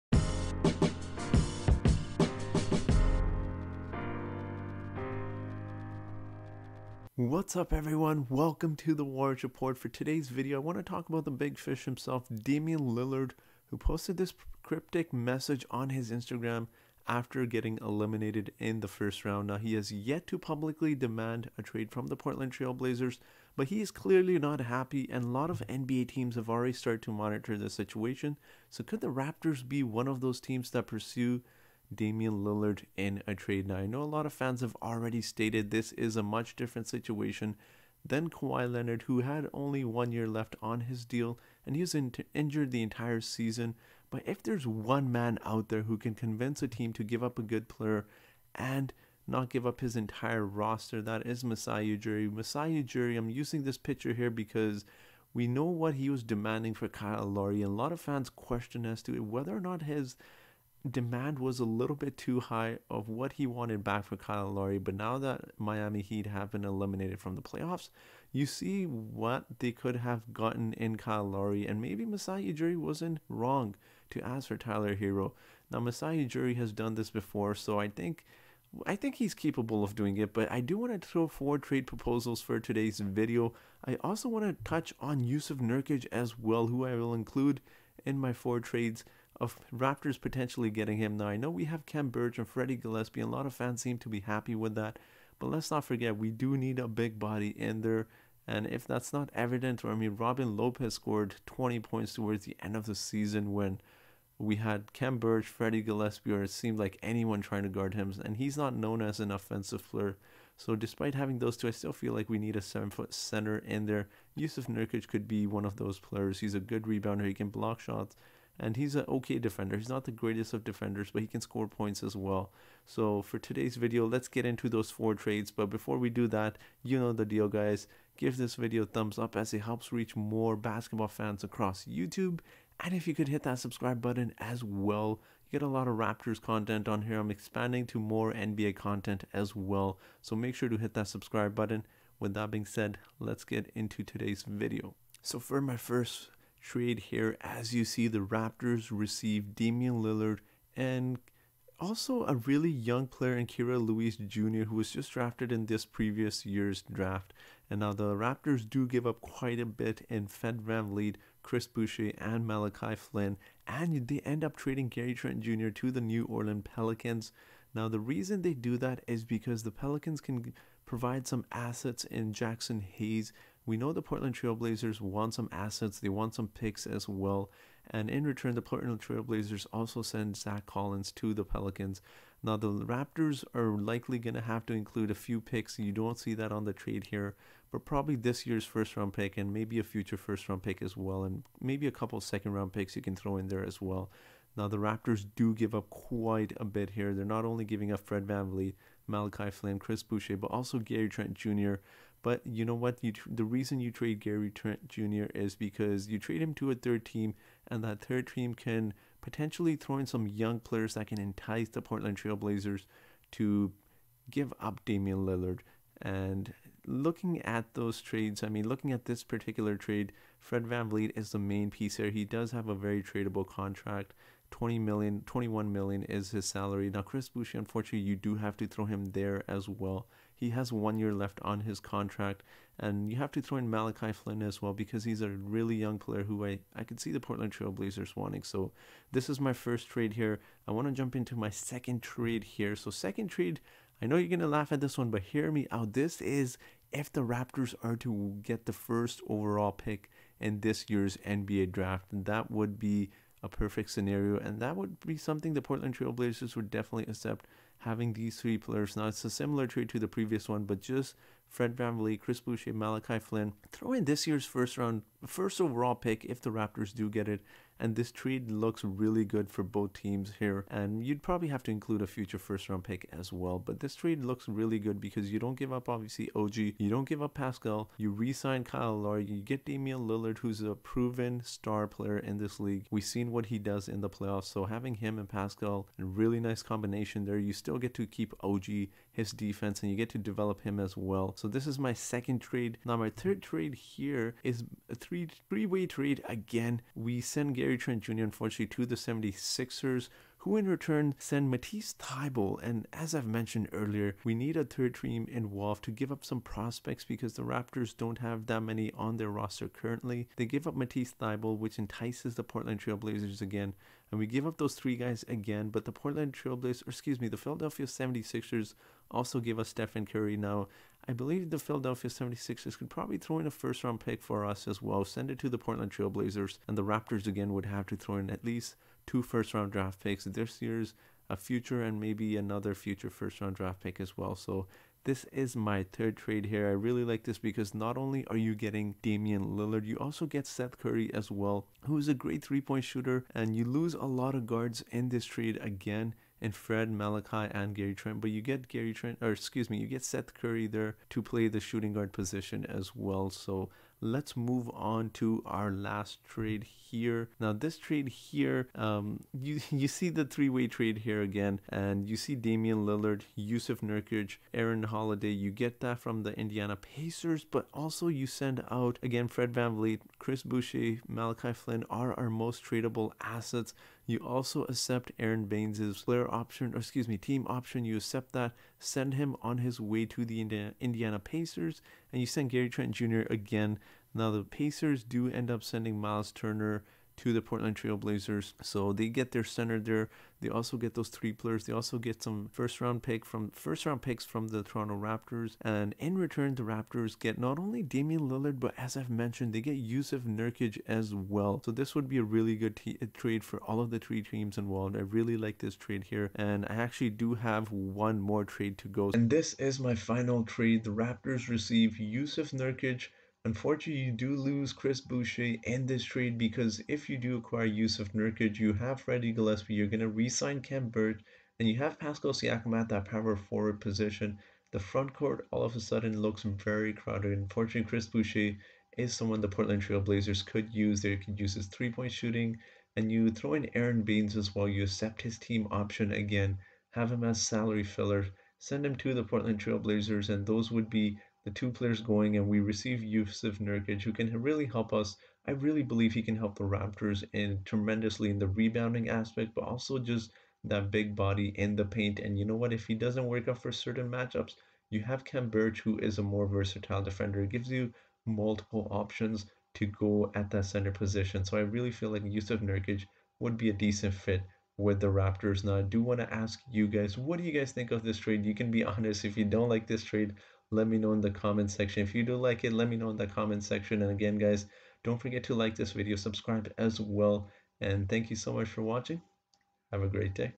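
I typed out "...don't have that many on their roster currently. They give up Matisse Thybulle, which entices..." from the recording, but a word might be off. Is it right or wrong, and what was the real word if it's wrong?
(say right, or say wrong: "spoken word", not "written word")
right.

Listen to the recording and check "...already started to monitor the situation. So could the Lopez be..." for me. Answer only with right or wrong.
wrong.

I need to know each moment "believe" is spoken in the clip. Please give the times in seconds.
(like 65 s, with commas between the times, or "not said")
321 s, 445 s.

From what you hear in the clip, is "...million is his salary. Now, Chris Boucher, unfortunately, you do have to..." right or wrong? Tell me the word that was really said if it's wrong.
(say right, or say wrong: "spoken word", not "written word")
right.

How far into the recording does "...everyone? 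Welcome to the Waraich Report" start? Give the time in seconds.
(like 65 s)
7 s.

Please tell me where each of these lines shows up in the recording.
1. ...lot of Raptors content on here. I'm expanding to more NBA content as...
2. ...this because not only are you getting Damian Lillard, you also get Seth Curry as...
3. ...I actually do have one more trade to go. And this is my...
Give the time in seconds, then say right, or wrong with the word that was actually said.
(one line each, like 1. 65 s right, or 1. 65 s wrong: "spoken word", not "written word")
1. 135 s right
2. 337 s right
3. 406 s right.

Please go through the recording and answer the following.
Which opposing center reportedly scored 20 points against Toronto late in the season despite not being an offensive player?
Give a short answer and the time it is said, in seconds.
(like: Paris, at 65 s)
Robin Lopez, at 100 s.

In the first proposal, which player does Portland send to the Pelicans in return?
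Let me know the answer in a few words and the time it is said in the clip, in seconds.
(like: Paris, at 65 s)
Zach Collins, at 180 s.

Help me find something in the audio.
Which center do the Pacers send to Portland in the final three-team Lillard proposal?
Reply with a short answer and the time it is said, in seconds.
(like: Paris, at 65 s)
Miles Turner, at 385 s.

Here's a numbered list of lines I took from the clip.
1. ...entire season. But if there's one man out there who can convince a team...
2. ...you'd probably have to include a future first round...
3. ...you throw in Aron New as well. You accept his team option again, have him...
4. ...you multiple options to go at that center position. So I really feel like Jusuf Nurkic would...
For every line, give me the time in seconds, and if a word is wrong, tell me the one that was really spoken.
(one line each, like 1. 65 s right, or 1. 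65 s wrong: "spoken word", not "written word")
1. 42 s right
2. 271 s right
3. 433 s wrong: "Baynes", not "New"
4. 457 s right.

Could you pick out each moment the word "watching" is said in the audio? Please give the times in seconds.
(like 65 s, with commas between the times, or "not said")
478 s.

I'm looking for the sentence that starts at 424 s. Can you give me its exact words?
The front court all of a sudden looks very crowded.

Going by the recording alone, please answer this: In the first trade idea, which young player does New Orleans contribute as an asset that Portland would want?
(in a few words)
Jaxson Hayes.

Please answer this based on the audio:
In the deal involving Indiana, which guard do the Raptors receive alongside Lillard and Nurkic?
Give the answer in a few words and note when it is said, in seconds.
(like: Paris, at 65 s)
Aaron Holiday, at 364 s.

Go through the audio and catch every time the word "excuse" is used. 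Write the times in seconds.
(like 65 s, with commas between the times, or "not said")
316 s, 349 s, 376 s.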